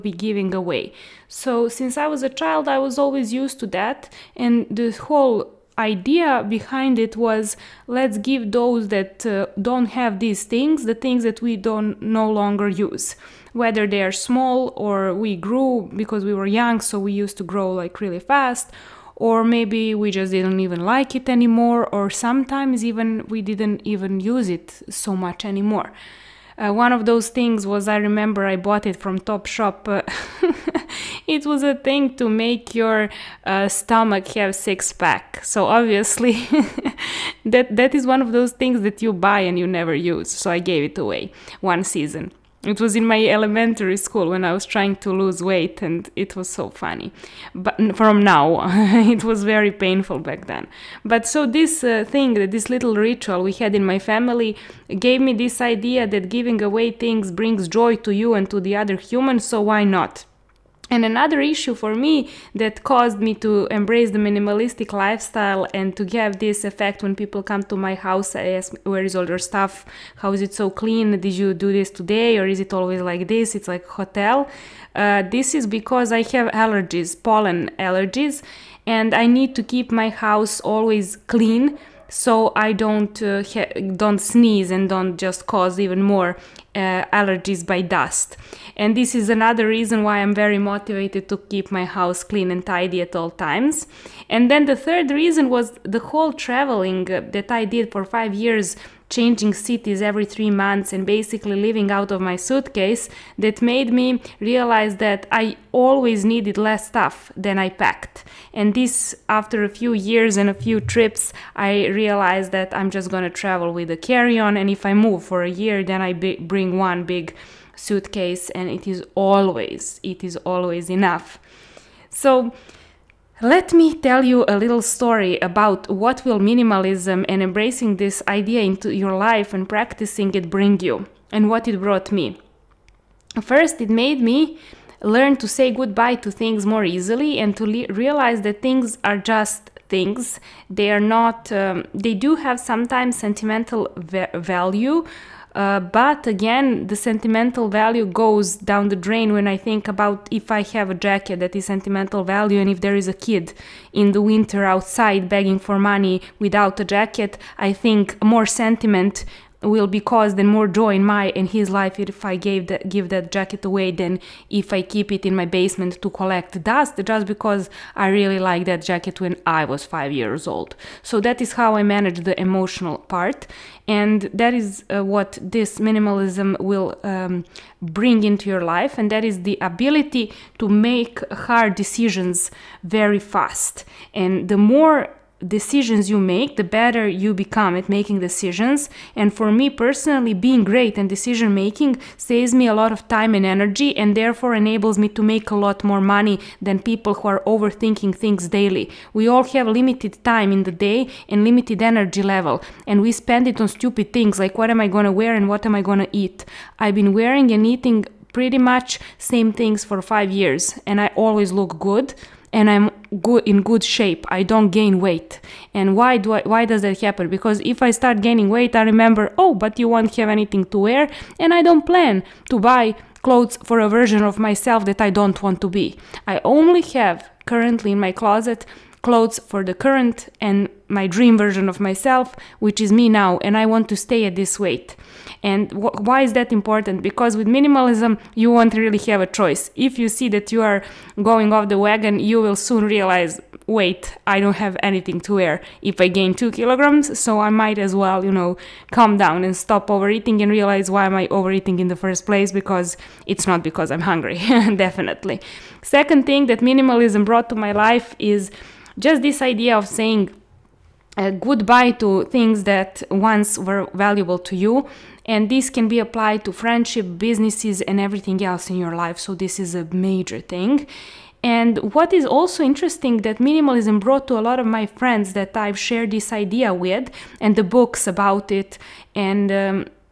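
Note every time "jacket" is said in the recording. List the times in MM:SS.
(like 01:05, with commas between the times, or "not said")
02:30, 02:36, 02:43, 02:48.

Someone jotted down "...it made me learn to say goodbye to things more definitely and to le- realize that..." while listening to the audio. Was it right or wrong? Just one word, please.
wrong.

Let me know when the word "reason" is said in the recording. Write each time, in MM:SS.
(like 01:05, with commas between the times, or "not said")
01:29, 01:35.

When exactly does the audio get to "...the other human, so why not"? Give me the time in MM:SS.
00:58.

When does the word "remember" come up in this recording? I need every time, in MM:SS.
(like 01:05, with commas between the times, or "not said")
00:27, 03:38.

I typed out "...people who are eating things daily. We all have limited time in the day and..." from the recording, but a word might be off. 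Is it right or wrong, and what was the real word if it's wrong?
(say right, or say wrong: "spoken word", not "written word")
wrong: "overthinking", not "eating".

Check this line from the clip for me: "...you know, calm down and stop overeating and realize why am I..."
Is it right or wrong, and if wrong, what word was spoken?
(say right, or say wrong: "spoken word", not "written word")
right.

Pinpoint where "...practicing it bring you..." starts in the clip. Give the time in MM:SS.
02:09.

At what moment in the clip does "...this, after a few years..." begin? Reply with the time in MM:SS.
01:48.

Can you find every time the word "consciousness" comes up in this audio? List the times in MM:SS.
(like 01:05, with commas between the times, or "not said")
not said.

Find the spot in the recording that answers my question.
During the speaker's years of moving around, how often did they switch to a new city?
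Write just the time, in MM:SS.
01:40.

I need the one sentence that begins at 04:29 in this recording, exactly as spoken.
So, this is a major thing.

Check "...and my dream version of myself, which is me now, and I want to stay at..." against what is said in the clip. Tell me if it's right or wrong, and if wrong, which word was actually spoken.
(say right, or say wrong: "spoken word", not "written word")
right.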